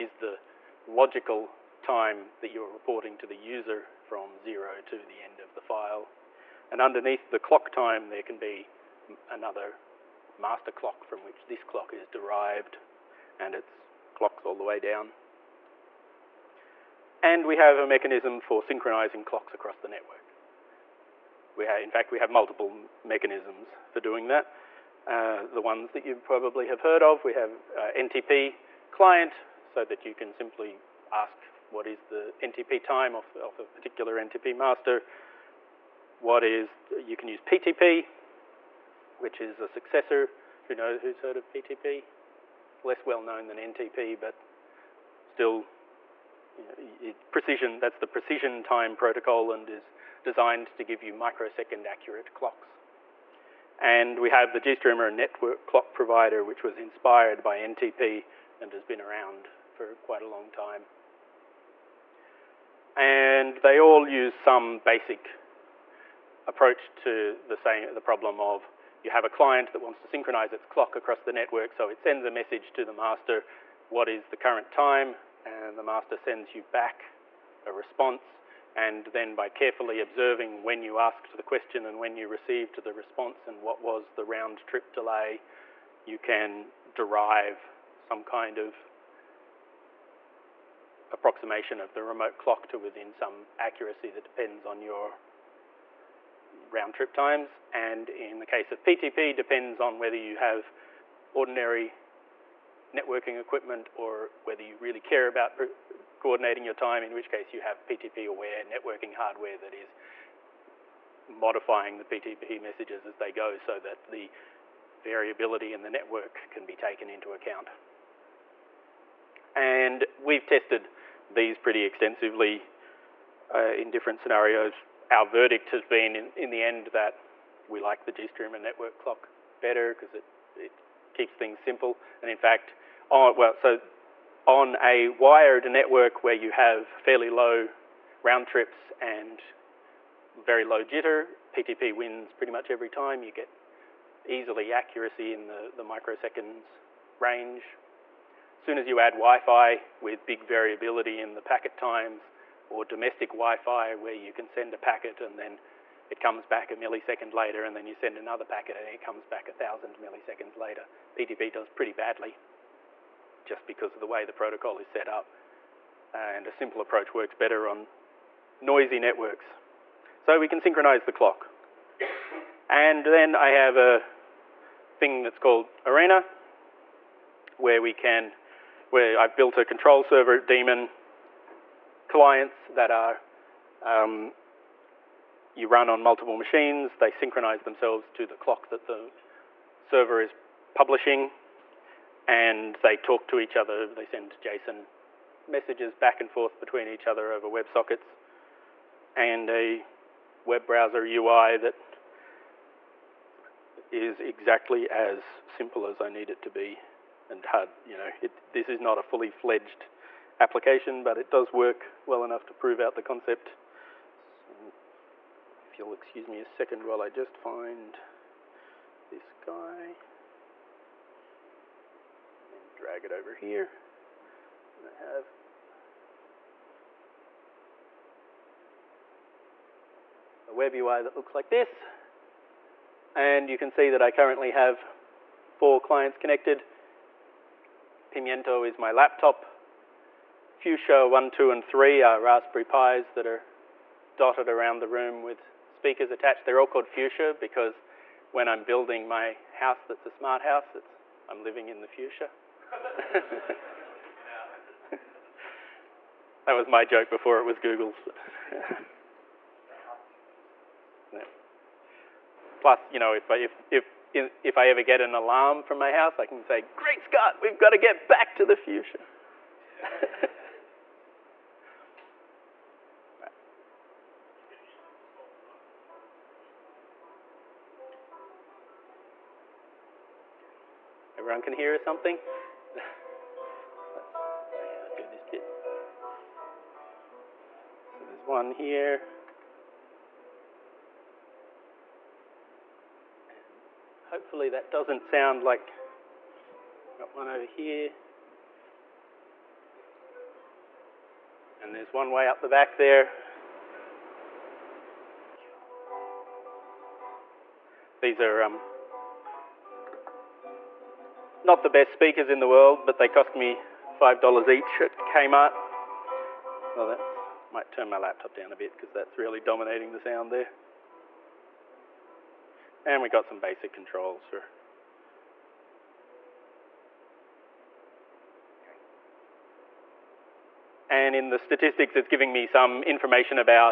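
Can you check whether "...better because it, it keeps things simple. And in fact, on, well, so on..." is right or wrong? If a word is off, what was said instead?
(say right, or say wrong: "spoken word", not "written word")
right.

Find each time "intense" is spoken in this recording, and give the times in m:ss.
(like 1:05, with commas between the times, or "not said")
not said.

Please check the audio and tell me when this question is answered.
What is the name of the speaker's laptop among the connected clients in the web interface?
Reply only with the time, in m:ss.
3:58.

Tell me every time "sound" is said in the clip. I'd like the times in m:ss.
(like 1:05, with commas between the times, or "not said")
4:55, 5:19.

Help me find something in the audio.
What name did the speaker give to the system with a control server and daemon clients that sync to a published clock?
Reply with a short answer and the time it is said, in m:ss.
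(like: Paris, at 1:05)
Arena, at 2:55.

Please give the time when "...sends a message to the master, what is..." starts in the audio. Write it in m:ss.
1:12.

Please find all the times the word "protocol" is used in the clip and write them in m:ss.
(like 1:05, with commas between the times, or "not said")
0:48, 2:44.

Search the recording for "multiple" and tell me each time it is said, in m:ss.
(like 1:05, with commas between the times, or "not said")
0:22, 3:06.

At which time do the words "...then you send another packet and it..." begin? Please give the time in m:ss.
2:37.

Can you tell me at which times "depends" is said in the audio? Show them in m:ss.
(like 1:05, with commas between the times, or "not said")
1:34, 1:39.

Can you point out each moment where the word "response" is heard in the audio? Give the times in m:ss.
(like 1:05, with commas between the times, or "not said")
1:17, 1:22.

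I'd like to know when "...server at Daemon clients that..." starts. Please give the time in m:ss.
3:00.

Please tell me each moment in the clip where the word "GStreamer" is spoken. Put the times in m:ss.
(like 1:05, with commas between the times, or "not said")
0:54, 2:08.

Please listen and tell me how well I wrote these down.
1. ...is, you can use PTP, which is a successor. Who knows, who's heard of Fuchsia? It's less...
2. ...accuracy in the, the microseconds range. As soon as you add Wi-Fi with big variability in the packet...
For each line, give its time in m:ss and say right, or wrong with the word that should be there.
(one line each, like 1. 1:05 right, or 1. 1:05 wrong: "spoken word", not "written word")
1. 0:36 wrong: "PTP", not "Fuchsia"
2. 2:24 right.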